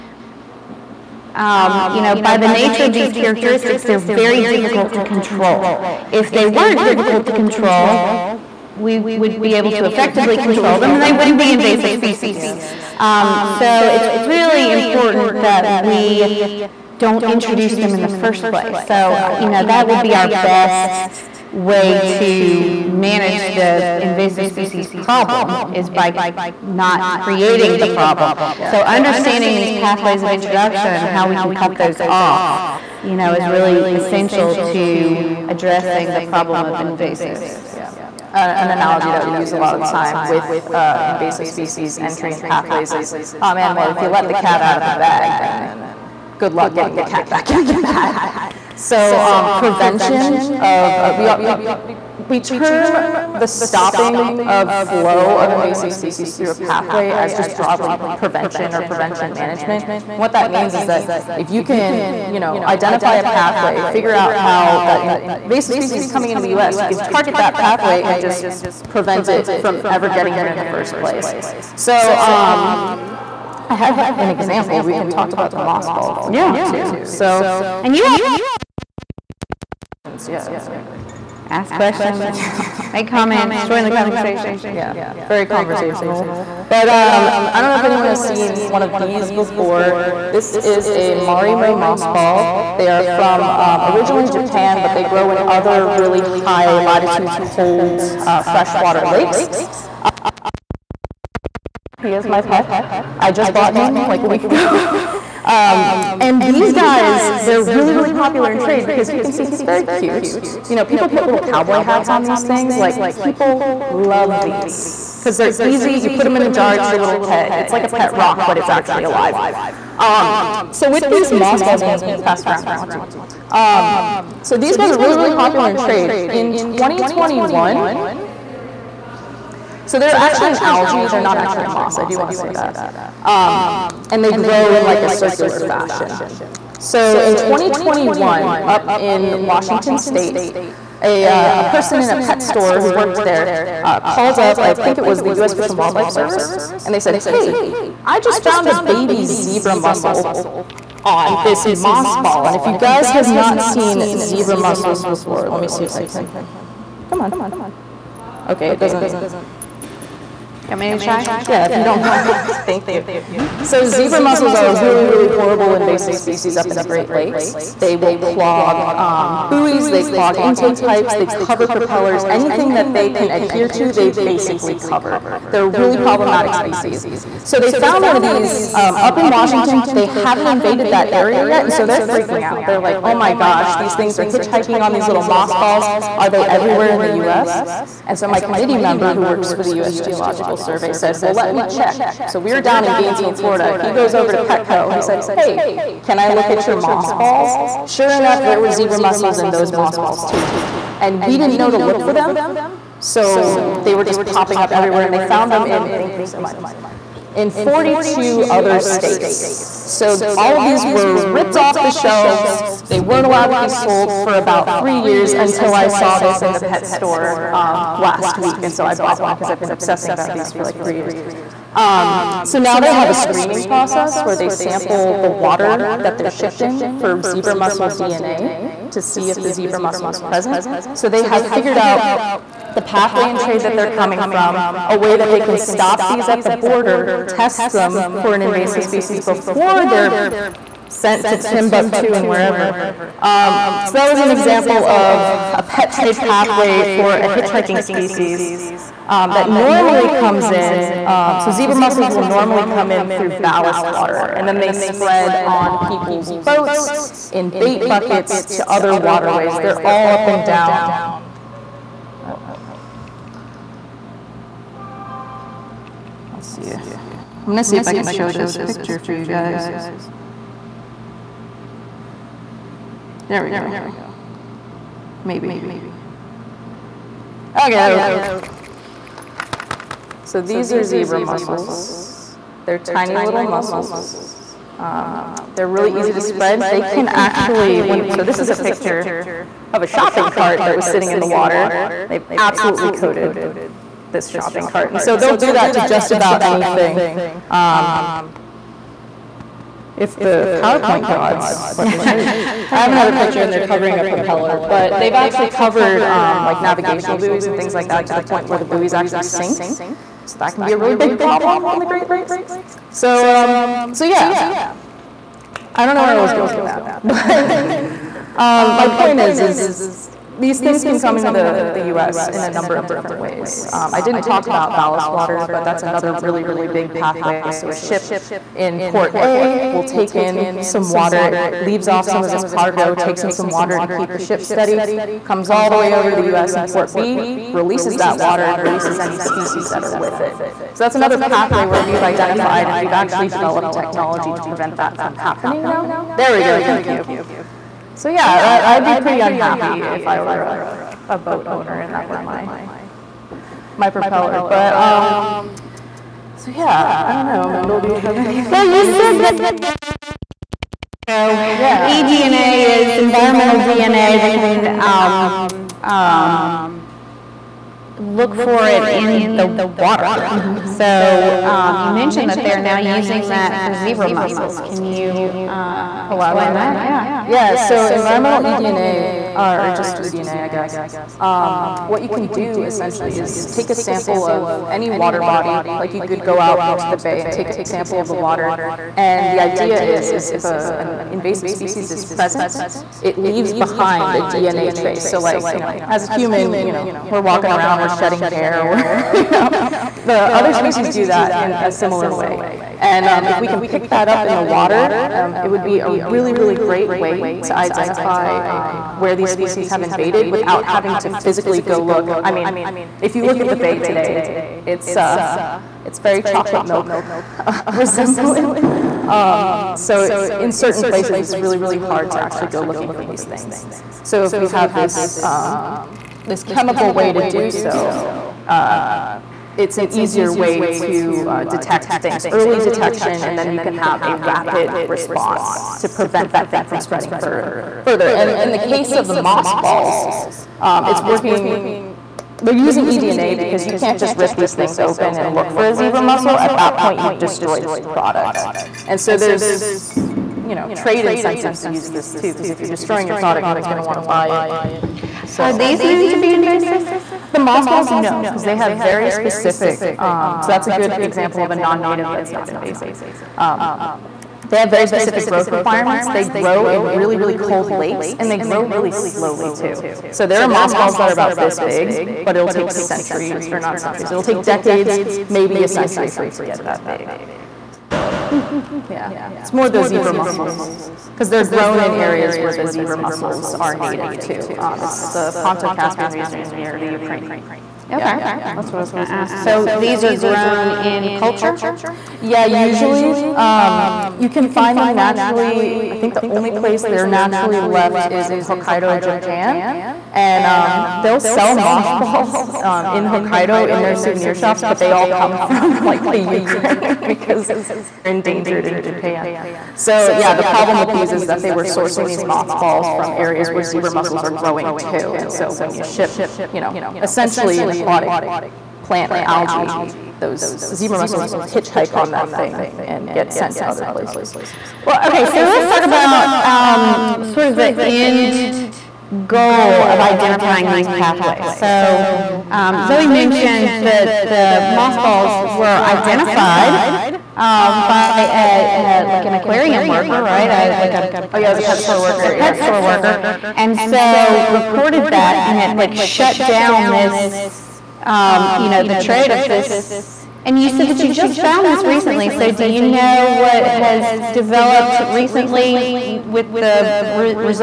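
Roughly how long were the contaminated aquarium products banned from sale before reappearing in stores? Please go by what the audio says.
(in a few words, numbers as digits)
about three years.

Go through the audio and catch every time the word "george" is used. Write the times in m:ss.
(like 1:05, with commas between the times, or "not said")
not said.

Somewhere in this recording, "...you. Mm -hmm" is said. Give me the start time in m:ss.
2:42.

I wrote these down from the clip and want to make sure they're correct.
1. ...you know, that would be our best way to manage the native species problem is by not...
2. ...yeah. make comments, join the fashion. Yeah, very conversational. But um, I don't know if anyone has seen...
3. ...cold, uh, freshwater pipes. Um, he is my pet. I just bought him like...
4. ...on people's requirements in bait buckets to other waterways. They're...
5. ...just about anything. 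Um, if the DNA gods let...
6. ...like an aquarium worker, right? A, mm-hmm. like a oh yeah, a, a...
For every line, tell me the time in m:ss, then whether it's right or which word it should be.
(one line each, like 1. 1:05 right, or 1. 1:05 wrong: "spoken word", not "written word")
1. 0:19 wrong: "invasive", not "native"
2. 1:22 wrong: "conversation", not "fashion"
3. 1:37 wrong: "lakes", not "pipes"
4. 4:15 wrong: "boats", not "requirements"
5. 4:55 wrong: "PowerPoint", not "DNA"
6. 8:59 right.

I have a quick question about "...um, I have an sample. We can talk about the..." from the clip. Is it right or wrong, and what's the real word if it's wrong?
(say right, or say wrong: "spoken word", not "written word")
wrong: "example", not "sample".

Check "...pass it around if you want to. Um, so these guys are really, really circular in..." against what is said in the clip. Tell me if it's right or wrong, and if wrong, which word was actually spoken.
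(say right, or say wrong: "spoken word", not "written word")
wrong: "popular", not "circular".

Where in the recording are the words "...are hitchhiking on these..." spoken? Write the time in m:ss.
3:04.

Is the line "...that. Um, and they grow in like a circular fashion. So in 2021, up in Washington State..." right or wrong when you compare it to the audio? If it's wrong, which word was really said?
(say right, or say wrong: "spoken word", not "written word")
right.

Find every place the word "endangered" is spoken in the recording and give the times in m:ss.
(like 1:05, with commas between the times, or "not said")
8:28.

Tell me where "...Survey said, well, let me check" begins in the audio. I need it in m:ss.
3:10.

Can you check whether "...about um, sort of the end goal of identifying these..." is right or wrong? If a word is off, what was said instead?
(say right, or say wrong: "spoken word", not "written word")
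right.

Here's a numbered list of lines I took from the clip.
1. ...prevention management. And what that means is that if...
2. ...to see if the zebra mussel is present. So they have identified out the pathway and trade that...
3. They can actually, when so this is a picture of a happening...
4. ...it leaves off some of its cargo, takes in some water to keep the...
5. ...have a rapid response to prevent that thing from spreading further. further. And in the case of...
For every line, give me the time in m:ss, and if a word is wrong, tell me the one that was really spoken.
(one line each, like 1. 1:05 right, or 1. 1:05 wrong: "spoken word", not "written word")
1. 0:58 right
2. 3:48 wrong: "figured", not "identified"
3. 4:46 wrong: "shopping", not "happening"
4. 5:31 right
5. 7:13 right.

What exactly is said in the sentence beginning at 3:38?
And so I bought one because I've been obsessing about these for like three years.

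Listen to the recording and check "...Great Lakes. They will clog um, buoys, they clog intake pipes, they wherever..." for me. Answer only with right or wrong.
wrong.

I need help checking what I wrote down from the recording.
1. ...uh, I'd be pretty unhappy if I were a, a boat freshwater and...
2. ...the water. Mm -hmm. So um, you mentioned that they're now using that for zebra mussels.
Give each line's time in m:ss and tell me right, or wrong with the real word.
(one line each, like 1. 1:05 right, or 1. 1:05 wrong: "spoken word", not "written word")
1. 5:48 wrong: "owner", not "freshwater"
2. 6:09 right.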